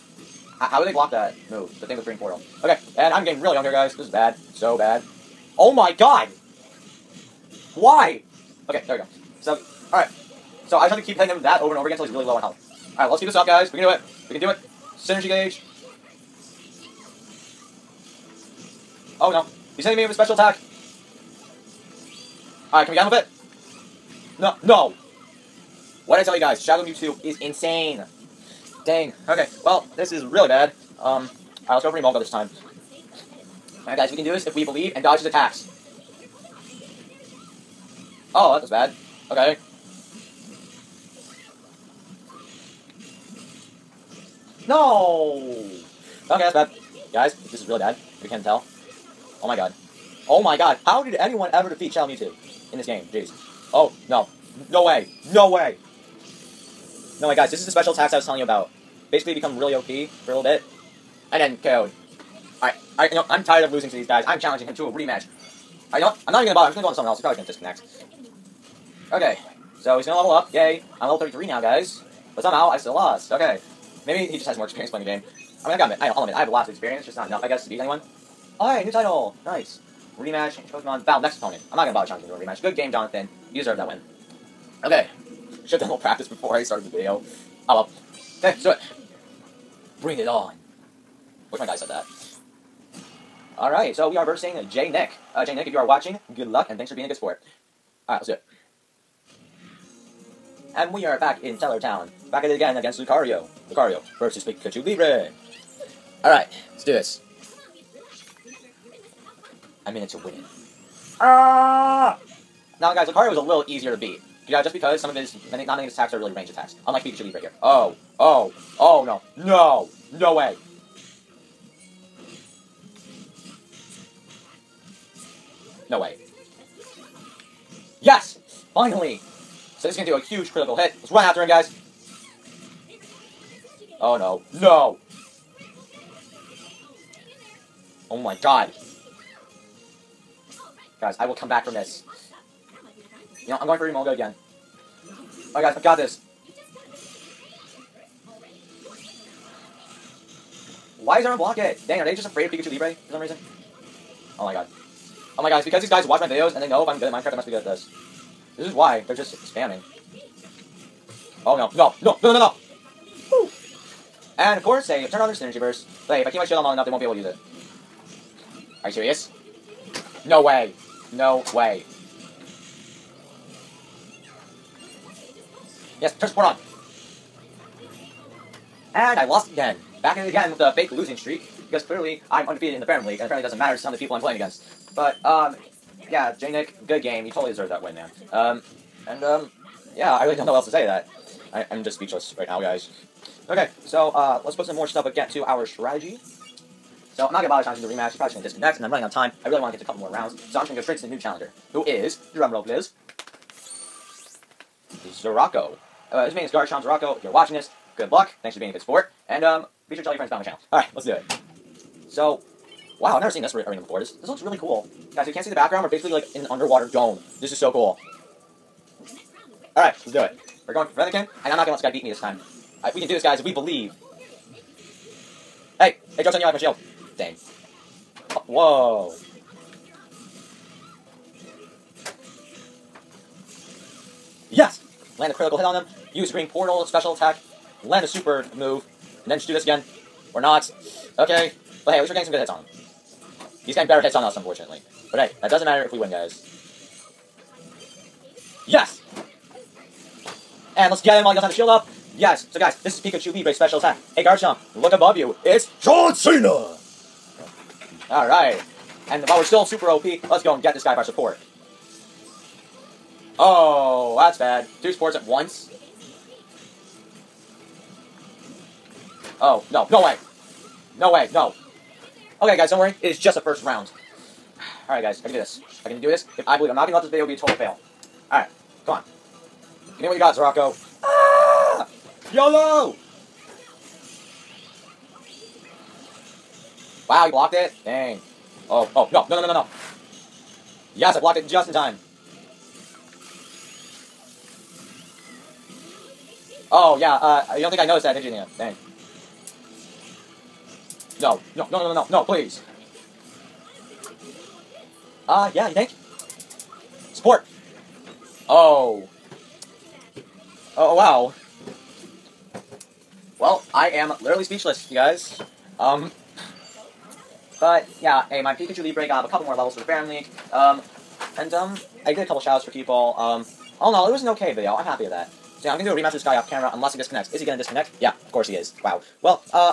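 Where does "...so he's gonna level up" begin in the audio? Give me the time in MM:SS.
01:09.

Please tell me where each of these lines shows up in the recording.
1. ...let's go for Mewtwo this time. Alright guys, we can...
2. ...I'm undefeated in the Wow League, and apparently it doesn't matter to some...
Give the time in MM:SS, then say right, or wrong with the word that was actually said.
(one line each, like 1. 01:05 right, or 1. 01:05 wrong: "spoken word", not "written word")
1. 00:31 wrong: "Emolga", not "Mewtwo"
2. 03:02 wrong: "Ferrum", not "Wow".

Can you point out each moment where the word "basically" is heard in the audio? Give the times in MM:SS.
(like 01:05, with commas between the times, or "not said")
00:59, 03:35.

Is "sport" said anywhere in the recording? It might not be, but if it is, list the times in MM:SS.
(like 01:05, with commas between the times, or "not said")
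01:37, 03:28.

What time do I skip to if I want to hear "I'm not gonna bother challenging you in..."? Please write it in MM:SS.
01:21.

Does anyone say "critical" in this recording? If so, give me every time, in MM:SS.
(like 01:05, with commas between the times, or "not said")
02:10, 03:55.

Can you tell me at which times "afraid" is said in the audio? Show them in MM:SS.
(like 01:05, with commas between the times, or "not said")
02:32.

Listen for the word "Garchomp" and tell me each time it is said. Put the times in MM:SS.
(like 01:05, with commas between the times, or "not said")
03:26, 04:14.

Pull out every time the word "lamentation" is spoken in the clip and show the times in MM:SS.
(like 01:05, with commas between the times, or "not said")
not said.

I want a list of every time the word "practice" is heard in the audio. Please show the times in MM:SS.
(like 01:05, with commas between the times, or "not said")
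01:25.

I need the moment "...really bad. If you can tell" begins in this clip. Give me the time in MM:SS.
00:47.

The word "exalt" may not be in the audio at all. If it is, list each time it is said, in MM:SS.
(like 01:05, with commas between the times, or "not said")
not said.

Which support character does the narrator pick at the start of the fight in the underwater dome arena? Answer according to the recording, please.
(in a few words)
Fennekin.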